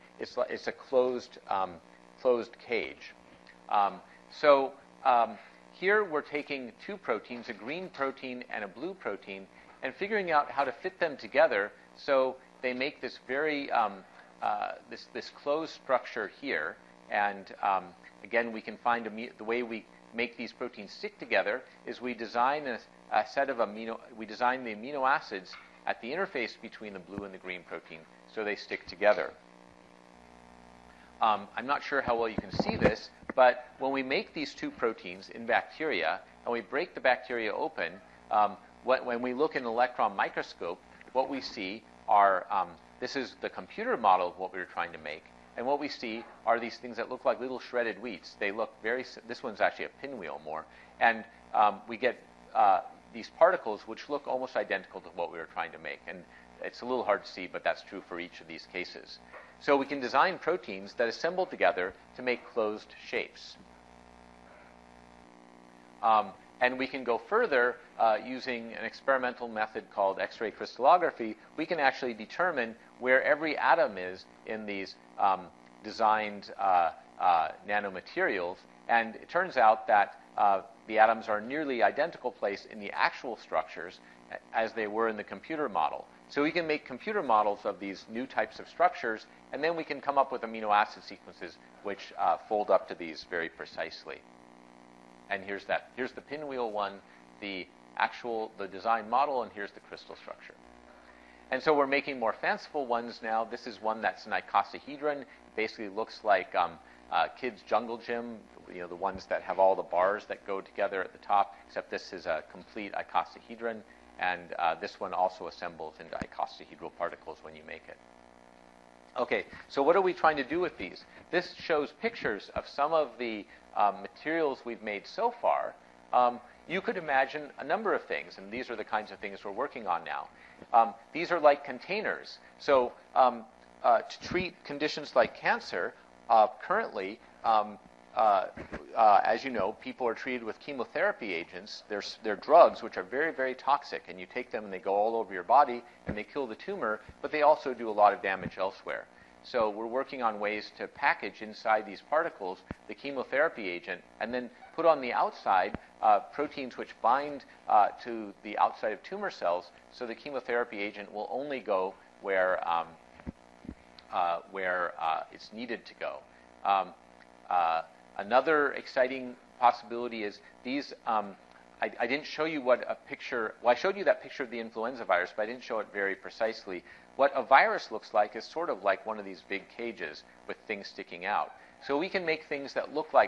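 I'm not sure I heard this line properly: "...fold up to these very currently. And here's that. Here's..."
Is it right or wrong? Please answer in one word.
wrong.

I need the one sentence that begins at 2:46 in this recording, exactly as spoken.
Um, uh, Another exciting possibility is these.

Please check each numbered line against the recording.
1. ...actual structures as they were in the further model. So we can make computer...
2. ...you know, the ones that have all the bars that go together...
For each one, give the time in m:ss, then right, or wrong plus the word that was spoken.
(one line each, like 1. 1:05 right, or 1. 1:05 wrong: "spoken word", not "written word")
1. 1:22 wrong: "computer", not "further"
2. 1:48 right.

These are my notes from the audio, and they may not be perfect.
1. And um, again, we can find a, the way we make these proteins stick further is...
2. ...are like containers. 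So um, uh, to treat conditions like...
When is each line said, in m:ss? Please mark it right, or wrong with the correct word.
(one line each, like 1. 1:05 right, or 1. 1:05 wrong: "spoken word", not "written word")
1. 0:17 wrong: "together", not "further"
2. 2:11 right.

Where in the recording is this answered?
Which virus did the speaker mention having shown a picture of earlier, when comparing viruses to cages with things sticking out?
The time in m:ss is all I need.
2:54.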